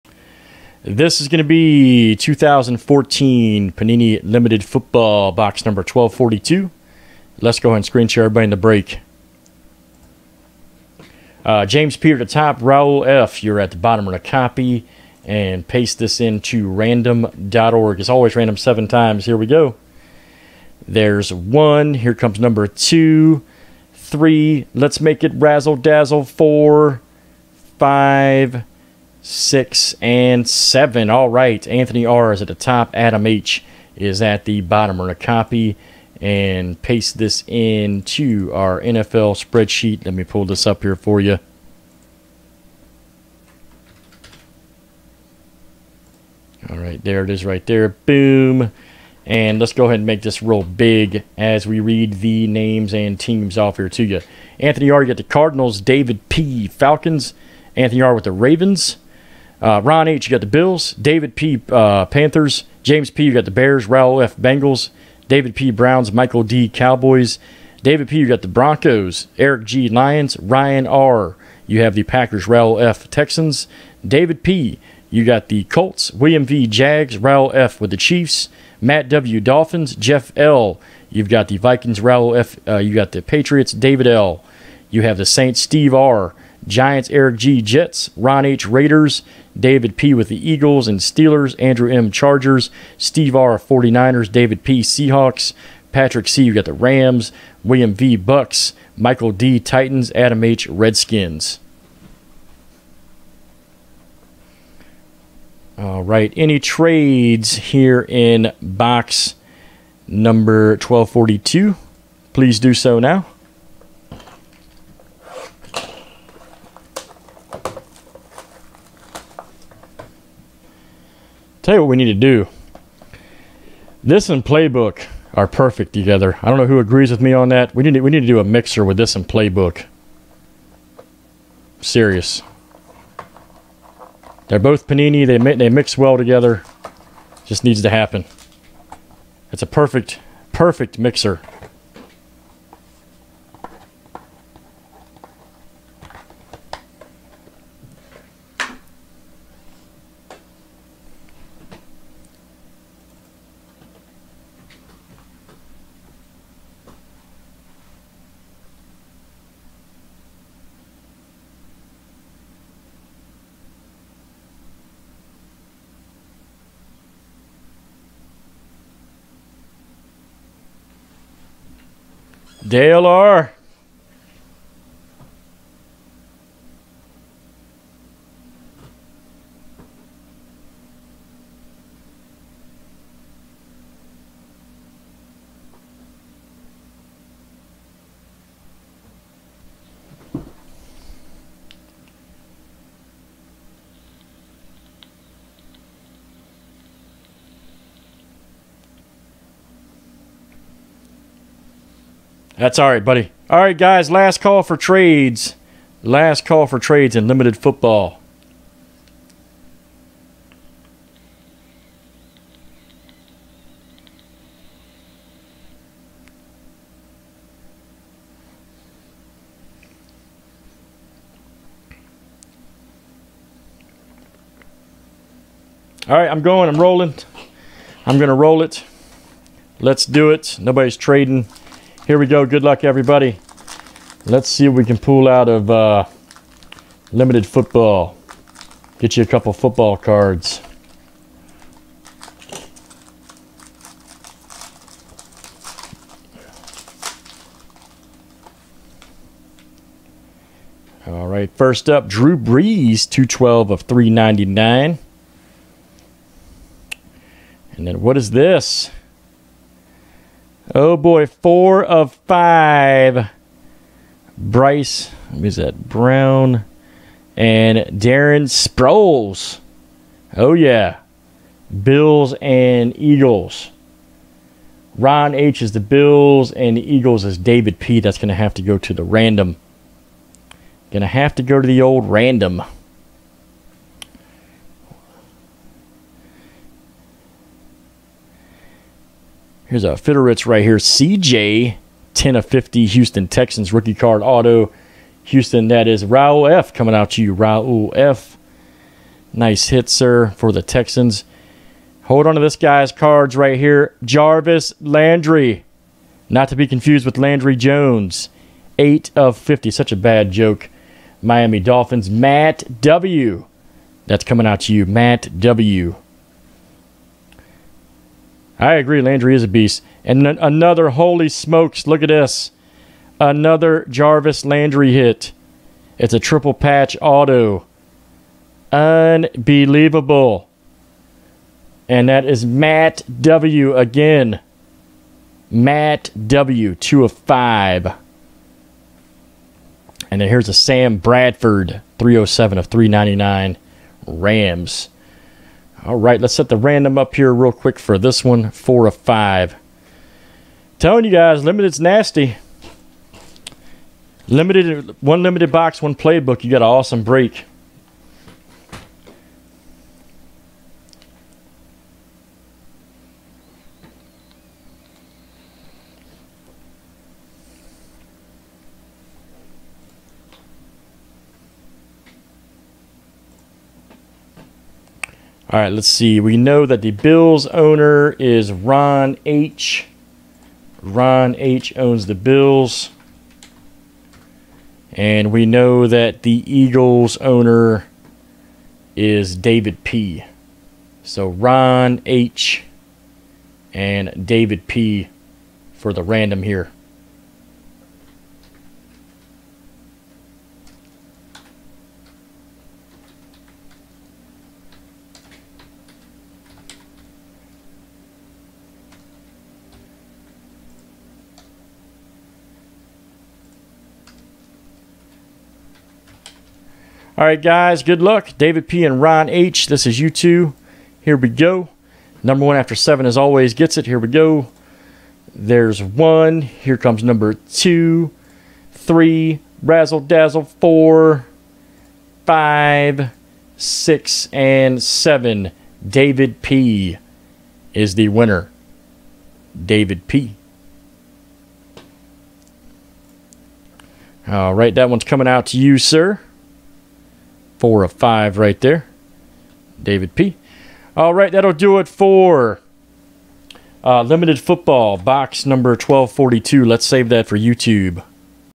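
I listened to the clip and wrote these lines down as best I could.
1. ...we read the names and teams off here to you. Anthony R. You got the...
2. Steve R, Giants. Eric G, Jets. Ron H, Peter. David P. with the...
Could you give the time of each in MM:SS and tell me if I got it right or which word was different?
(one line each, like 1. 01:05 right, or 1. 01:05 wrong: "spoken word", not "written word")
1. 00:51 right
2. 01:25 wrong: "Raiders", not "Peter".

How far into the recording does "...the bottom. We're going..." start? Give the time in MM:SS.
00:34.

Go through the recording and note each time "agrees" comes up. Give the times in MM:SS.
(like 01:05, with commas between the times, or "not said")
02:06, 05:18.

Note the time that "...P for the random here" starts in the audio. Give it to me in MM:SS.
06:34.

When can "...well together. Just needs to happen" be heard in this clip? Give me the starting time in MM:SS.
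02:15.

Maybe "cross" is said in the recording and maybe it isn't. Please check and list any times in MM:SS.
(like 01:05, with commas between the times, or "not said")
not said.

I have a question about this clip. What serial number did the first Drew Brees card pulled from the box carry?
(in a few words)
212 of 399.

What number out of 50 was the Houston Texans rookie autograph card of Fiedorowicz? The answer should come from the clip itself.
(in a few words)
10.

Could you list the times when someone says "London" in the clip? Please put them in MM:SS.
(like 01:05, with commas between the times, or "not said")
not said.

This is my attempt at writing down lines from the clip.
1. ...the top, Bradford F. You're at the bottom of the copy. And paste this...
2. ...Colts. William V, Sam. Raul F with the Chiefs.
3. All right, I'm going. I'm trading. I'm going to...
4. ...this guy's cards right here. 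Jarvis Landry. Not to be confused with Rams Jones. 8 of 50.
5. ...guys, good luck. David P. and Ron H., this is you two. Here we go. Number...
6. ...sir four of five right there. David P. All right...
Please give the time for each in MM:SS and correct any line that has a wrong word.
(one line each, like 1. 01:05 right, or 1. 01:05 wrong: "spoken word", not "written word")
1. 00:12 wrong: "Raul", not "Bradford"
2. 01:15 wrong: "Jags", not "Sam"
3. 03:46 wrong: "rolling", not "trading"
4. 05:02 wrong: "Landry", not "Rams"
5. 06:57 right
6. 07:25 right.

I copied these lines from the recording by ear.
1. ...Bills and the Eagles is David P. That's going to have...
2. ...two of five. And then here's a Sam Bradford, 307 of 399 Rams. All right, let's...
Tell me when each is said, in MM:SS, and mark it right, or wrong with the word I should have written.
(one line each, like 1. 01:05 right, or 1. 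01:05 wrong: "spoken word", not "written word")
1. 04:35 right
2. 05:36 right.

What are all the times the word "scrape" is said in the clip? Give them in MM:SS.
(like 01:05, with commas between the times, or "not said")
not said.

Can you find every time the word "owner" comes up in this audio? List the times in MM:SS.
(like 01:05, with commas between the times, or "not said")
06:17, 06:27.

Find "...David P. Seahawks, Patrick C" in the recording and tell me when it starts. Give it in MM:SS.
01:34.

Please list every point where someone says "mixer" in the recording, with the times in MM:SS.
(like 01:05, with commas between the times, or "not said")
02:08, 02:20.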